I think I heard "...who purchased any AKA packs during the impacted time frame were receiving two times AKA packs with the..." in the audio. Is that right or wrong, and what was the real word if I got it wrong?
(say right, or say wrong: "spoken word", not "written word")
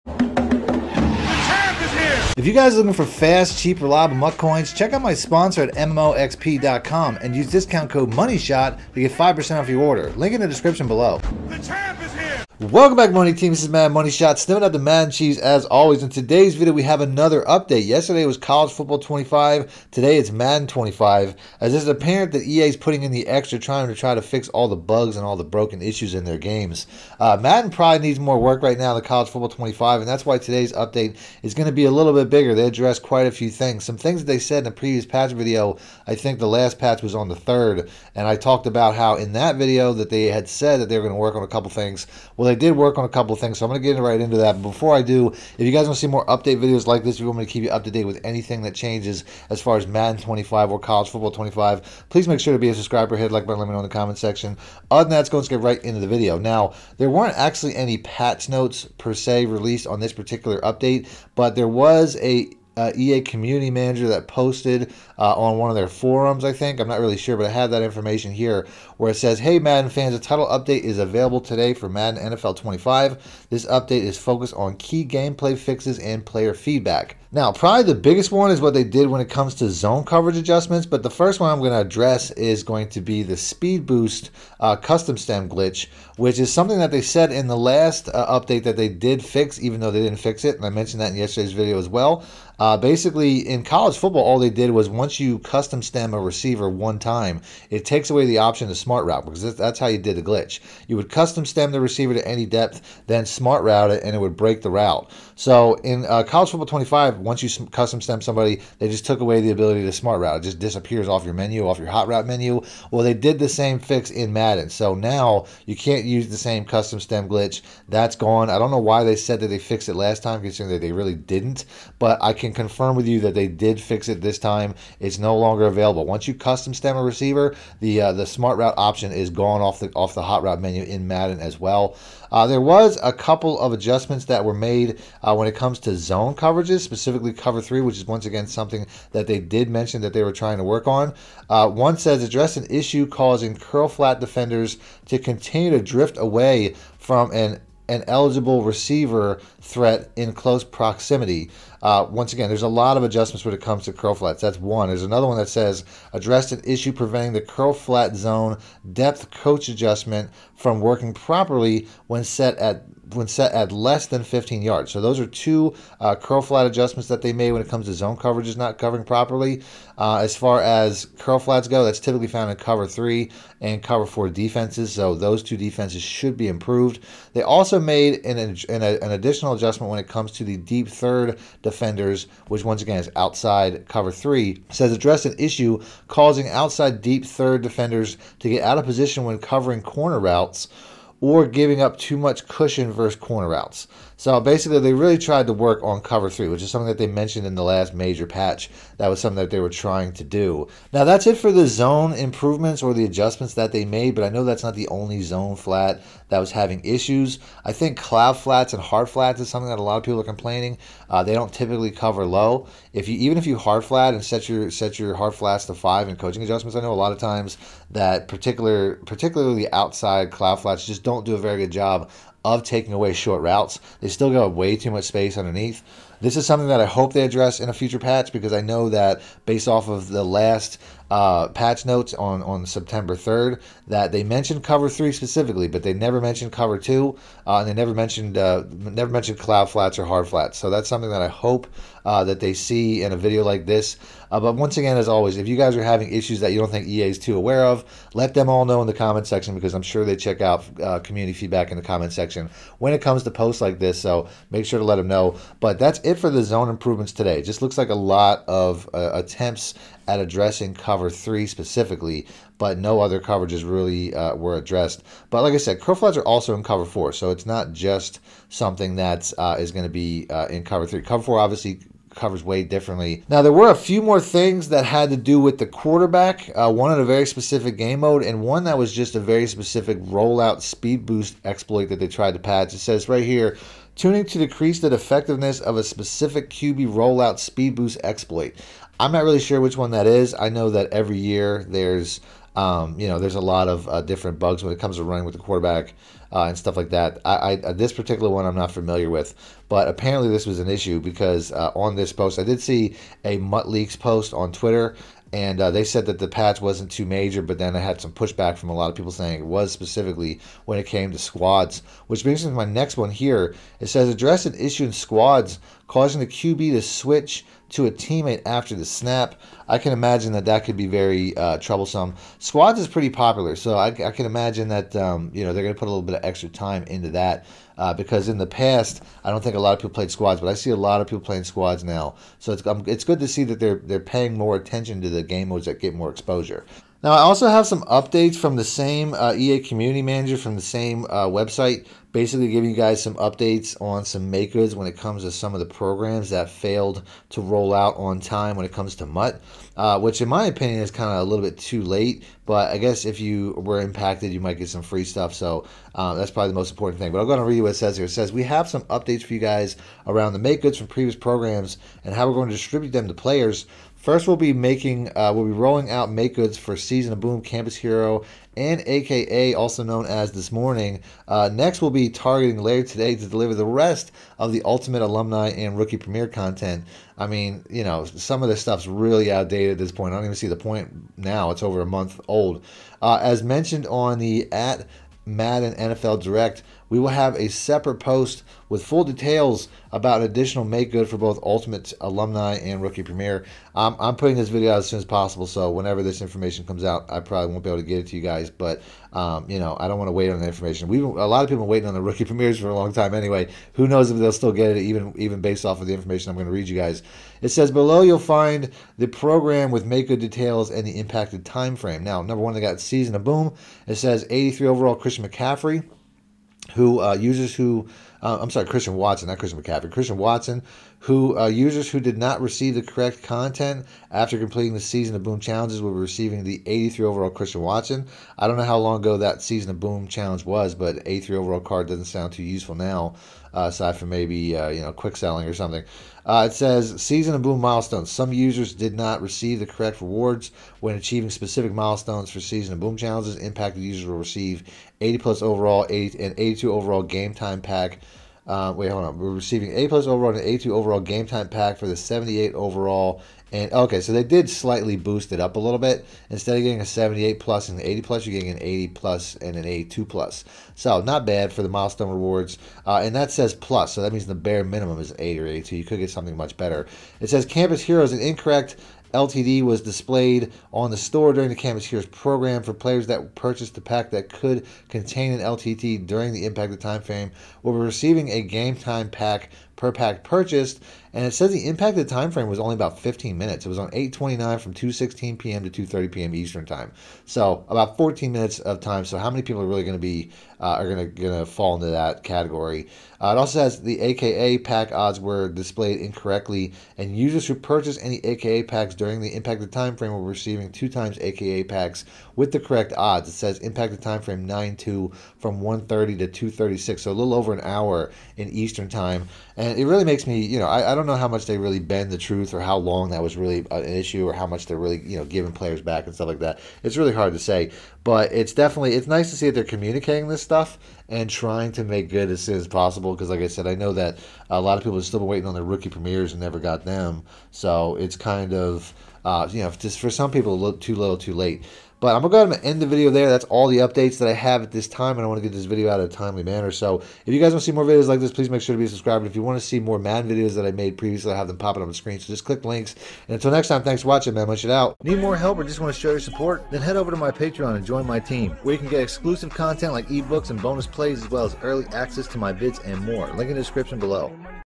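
right.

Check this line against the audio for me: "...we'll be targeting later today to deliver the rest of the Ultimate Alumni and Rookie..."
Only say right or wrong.
right.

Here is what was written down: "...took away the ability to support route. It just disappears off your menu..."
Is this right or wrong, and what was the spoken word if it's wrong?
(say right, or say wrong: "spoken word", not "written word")
wrong: "smart", not "support".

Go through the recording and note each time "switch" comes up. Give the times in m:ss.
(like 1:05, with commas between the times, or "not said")
5:16.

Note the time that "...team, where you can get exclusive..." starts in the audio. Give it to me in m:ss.
9:08.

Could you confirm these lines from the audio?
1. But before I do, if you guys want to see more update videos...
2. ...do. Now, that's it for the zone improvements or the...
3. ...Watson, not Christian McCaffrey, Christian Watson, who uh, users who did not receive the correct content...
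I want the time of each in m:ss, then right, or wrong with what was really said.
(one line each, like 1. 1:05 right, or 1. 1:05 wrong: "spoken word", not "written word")
1. 0:44 right
2. 3:20 right
3. 6:58 right.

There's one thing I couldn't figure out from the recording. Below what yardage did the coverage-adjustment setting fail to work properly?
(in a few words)
15 yards.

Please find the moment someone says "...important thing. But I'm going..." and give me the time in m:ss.
5:56.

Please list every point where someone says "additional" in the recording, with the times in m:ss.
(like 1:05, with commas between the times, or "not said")
2:59, 6:30.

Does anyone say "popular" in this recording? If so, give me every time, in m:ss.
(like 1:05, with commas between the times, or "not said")
5:23.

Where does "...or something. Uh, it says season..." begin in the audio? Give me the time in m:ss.
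7:15.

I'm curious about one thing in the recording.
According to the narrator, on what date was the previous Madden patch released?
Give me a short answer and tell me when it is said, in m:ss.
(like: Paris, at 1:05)
the third, at 0:37.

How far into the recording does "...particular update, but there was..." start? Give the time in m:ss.
1:00.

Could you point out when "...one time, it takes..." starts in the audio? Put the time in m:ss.
1:36.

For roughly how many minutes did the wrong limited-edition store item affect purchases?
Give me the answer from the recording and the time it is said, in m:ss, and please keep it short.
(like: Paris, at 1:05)
14 minutes, at 8:07.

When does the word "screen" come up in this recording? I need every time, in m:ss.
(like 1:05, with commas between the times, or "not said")
9:01.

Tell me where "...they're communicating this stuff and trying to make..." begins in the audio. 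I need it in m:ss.
8:39.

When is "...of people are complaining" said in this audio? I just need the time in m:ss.
3:29.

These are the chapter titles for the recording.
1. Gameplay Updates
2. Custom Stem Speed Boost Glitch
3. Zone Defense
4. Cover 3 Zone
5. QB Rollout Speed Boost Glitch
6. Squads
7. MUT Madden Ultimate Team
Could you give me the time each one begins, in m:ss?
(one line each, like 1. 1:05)
1. 1:08
2. 1:21
3. 2:12
4. 2:57
5. 4:33
6. 5:10
7. 5:36.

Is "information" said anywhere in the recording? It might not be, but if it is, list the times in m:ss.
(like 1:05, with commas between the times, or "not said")
1:07, 6:36, 6:40, 6:45.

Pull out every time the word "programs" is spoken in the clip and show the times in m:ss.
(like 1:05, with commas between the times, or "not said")
5:45, 6:01, 6:49, 7:52.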